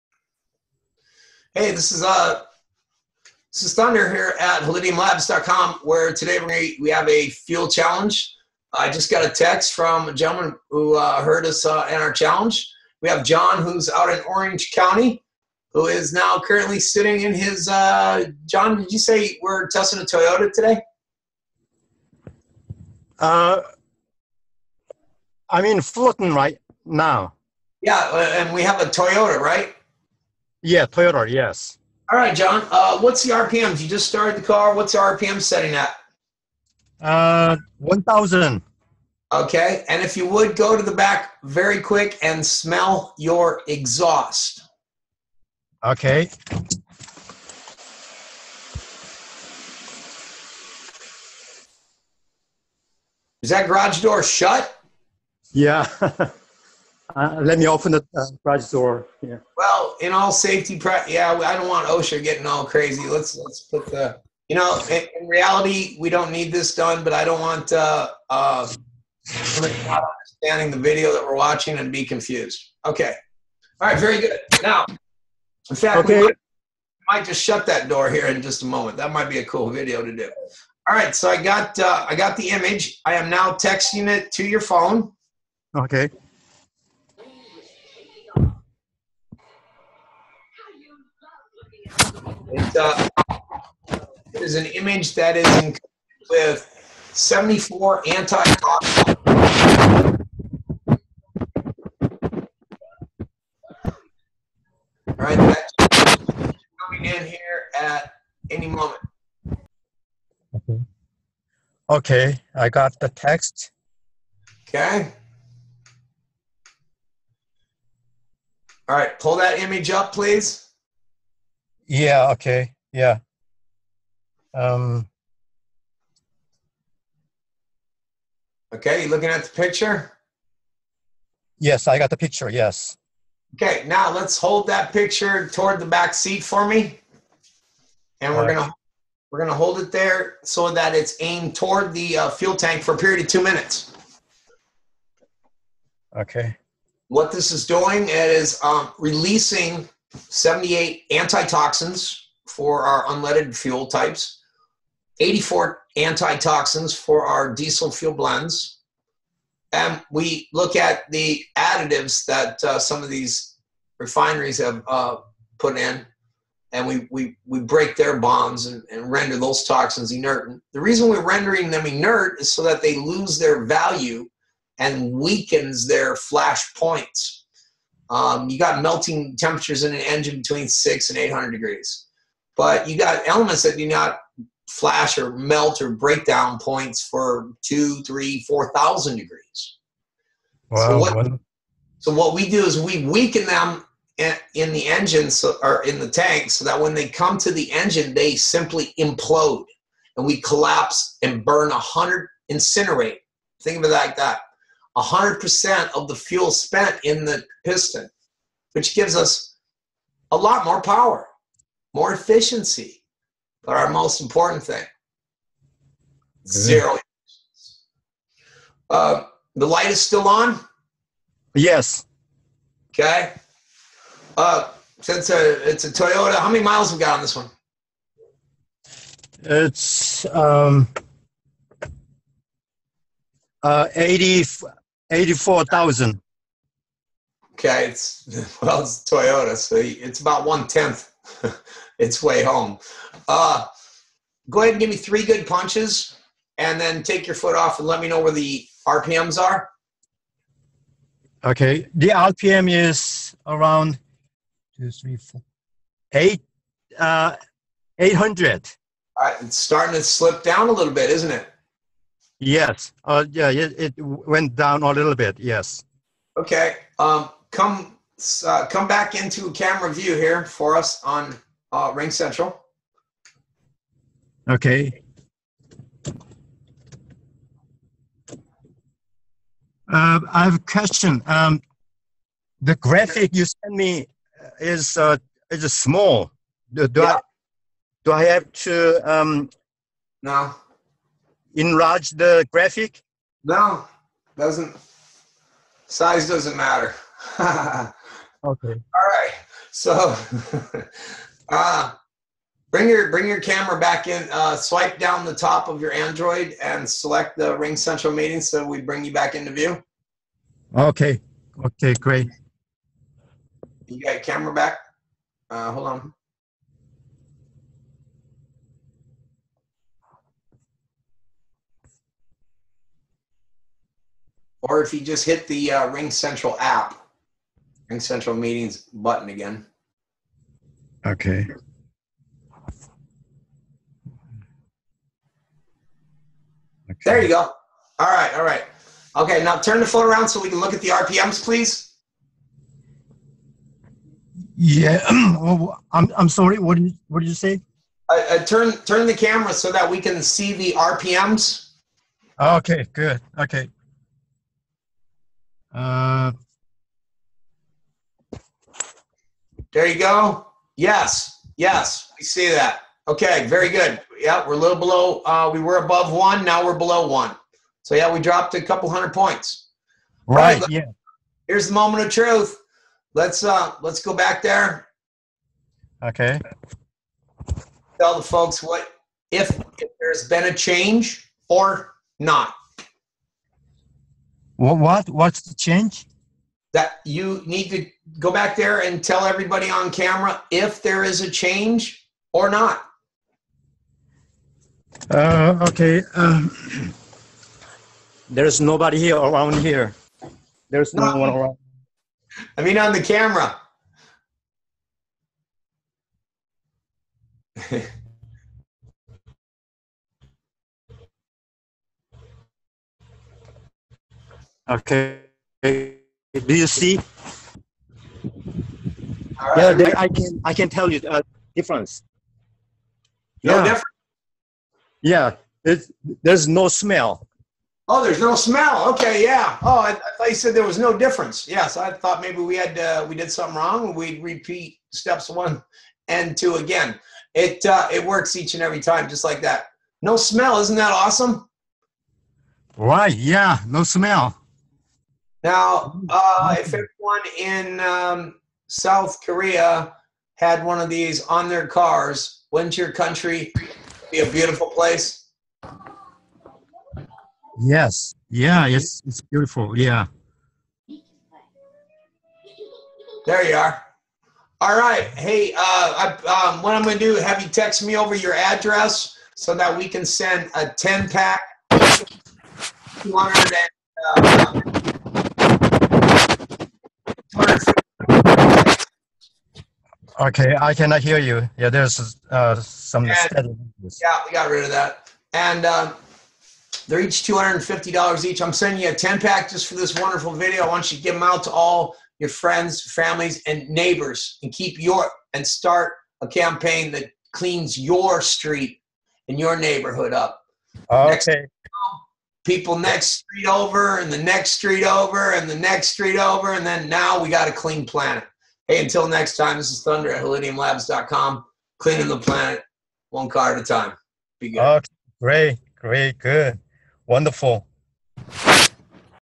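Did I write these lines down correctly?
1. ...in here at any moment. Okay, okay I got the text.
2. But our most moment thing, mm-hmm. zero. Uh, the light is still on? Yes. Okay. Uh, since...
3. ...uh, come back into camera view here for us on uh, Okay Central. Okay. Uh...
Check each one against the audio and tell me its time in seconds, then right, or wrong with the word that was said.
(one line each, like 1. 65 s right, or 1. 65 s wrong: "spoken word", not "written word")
1. 107 s right
2. 213 s wrong: "important", not "moment"
3. 268 s wrong: "Ring", not "Okay".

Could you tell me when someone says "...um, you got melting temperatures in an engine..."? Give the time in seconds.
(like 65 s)
178 s.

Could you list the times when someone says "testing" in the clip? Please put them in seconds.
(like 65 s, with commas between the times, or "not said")
19 s.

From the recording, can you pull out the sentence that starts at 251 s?
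Okay, the RPM is around two, three, four, eight, uh, eight hundred.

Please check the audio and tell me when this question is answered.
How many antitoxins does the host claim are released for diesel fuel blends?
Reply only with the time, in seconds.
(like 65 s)
155 s.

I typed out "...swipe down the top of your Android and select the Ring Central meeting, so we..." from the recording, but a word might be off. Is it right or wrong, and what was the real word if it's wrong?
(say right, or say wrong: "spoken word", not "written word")
right.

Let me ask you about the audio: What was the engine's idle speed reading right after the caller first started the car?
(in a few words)
1,000.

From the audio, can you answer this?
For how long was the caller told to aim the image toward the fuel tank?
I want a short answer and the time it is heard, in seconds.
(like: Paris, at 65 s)
two minutes, at 143 s.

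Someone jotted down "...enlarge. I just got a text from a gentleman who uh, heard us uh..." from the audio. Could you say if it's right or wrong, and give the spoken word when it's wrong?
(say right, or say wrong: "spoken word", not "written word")
wrong: "challenge", not "enlarge".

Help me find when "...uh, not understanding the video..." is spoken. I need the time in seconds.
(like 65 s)
68 s.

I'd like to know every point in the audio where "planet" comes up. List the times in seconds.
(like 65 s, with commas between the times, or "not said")
507 s, 512 s.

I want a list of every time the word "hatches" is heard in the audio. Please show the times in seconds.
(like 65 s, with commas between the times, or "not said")
not said.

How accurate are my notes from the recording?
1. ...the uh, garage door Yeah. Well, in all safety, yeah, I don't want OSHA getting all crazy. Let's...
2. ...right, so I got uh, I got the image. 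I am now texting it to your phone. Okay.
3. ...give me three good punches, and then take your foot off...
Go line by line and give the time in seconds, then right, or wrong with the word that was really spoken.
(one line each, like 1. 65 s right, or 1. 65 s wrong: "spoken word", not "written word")
1. 57 s right
2. 80 s right
3. 244 s right.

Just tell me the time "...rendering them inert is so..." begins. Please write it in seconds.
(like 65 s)
171 s.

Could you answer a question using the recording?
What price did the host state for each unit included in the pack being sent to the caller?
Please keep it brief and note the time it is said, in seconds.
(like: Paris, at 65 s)
$250, at 487 s.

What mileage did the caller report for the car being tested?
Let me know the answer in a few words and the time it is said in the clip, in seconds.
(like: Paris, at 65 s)
84,000, at 235 s.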